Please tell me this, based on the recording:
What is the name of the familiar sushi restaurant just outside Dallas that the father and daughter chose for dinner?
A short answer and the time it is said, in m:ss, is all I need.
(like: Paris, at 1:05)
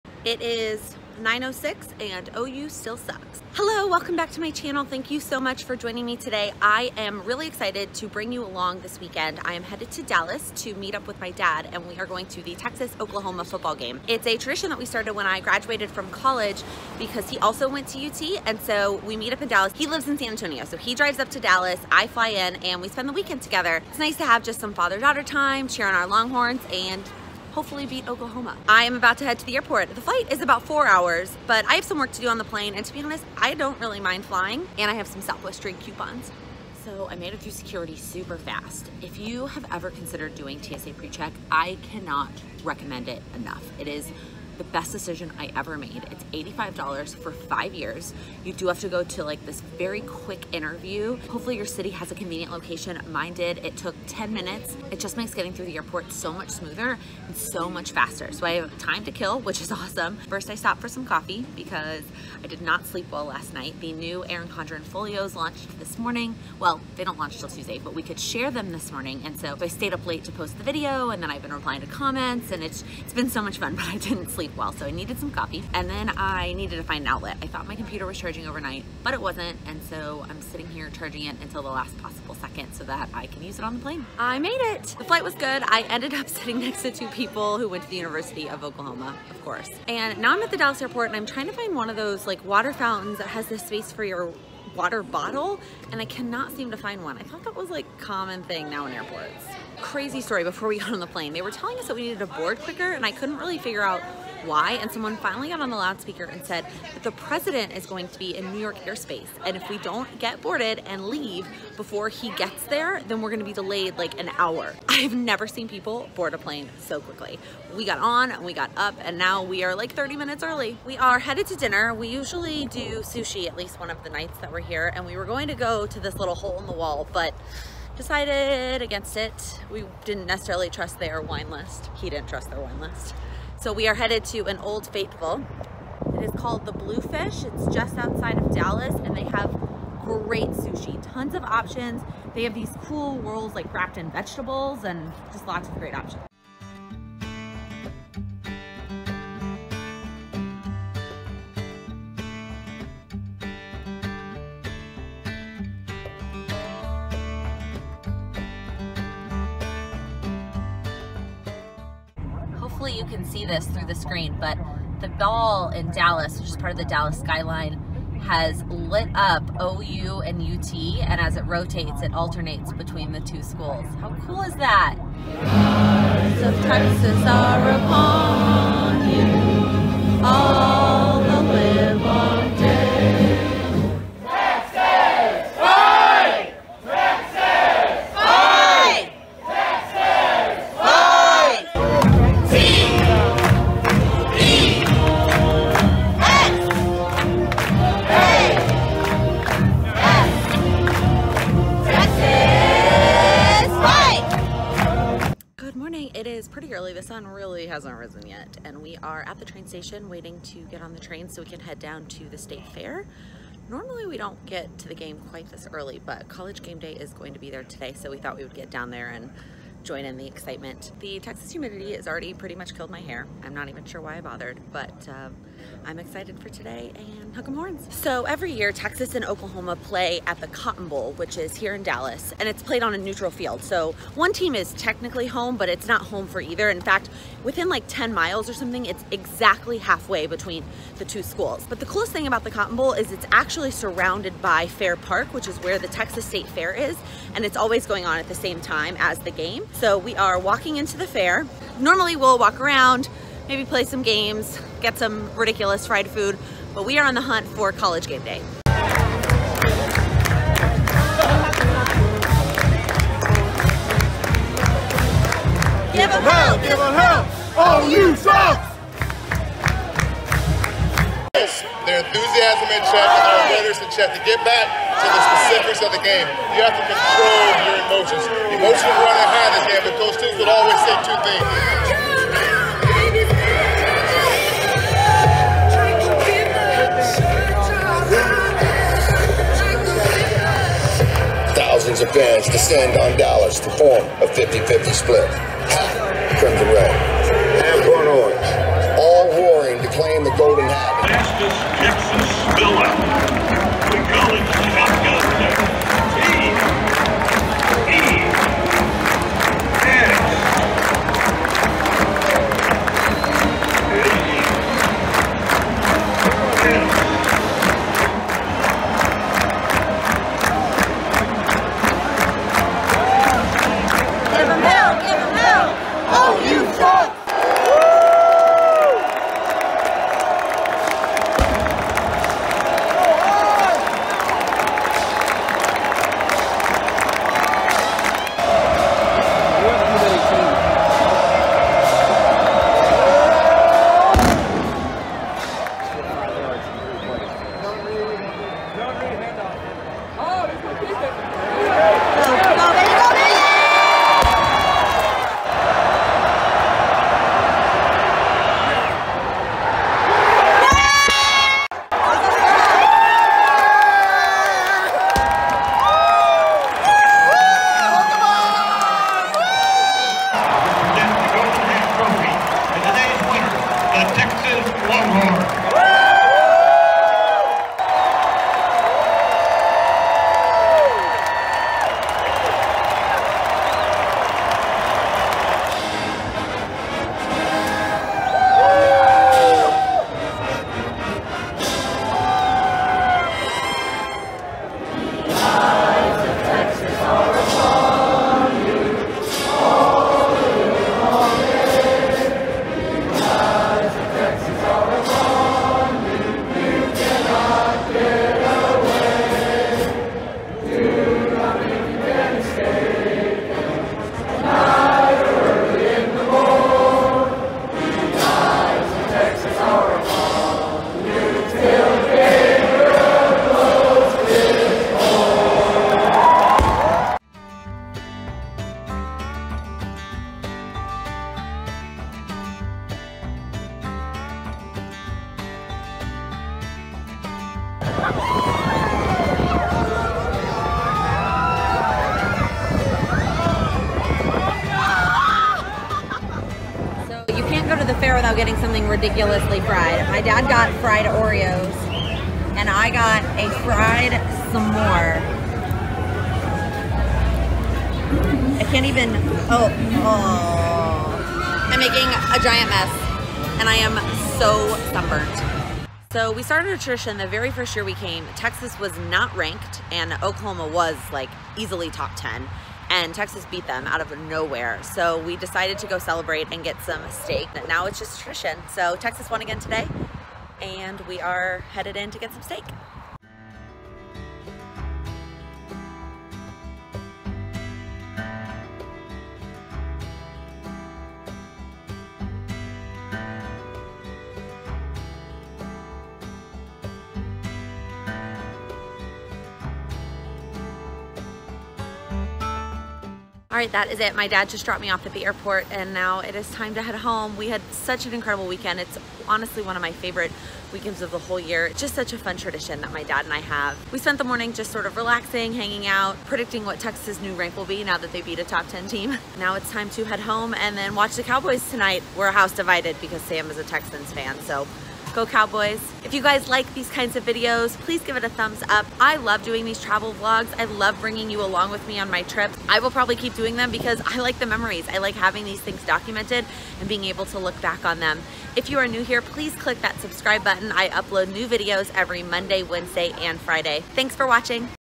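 Bluefish, at 2:16.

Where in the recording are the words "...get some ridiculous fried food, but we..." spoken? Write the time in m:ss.
4:14.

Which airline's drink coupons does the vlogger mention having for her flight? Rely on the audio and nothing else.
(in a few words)
Southwest.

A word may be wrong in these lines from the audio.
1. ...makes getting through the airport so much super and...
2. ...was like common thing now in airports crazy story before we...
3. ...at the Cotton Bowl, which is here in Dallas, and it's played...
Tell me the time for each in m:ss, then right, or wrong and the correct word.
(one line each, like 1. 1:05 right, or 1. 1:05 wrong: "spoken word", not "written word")
1. 0:55 wrong: "smoother", not "super"
2. 1:37 right
3. 3:50 right.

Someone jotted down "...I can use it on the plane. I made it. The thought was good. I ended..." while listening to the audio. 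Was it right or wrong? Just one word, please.
wrong.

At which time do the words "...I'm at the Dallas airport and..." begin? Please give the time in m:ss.
1:30.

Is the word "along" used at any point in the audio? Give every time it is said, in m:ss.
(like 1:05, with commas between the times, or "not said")
0:08, 8:51.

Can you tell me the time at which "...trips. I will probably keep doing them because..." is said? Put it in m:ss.
8:52.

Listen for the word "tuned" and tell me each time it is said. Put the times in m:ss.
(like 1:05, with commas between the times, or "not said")
not said.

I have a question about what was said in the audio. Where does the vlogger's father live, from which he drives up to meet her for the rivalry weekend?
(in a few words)
San Antonio.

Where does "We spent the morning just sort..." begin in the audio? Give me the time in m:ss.
8:33.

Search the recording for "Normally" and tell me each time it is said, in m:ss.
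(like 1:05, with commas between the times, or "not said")
3:33, 4:11.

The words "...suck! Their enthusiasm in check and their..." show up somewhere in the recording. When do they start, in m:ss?
4:28.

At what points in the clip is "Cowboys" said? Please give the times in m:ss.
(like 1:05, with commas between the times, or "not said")
8:41, 8:45.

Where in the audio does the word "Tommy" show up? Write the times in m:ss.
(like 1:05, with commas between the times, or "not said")
not said.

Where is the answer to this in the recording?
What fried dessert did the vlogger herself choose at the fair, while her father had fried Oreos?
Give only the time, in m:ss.
7:33.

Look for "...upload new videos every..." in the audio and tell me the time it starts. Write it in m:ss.
9:00.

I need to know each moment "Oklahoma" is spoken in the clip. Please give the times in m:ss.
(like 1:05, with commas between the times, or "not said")
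0:12, 0:28, 1:28, 3:49, 7:50.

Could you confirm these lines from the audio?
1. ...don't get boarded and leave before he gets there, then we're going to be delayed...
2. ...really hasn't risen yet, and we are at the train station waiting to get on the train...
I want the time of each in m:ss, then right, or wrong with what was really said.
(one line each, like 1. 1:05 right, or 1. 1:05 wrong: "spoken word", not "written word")
1. 1:49 right
2. 3:27 right.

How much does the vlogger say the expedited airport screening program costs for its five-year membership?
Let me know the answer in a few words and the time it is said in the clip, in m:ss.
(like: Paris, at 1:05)
$85, at 0:46.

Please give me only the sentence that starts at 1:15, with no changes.
And then I needed to find an outlet.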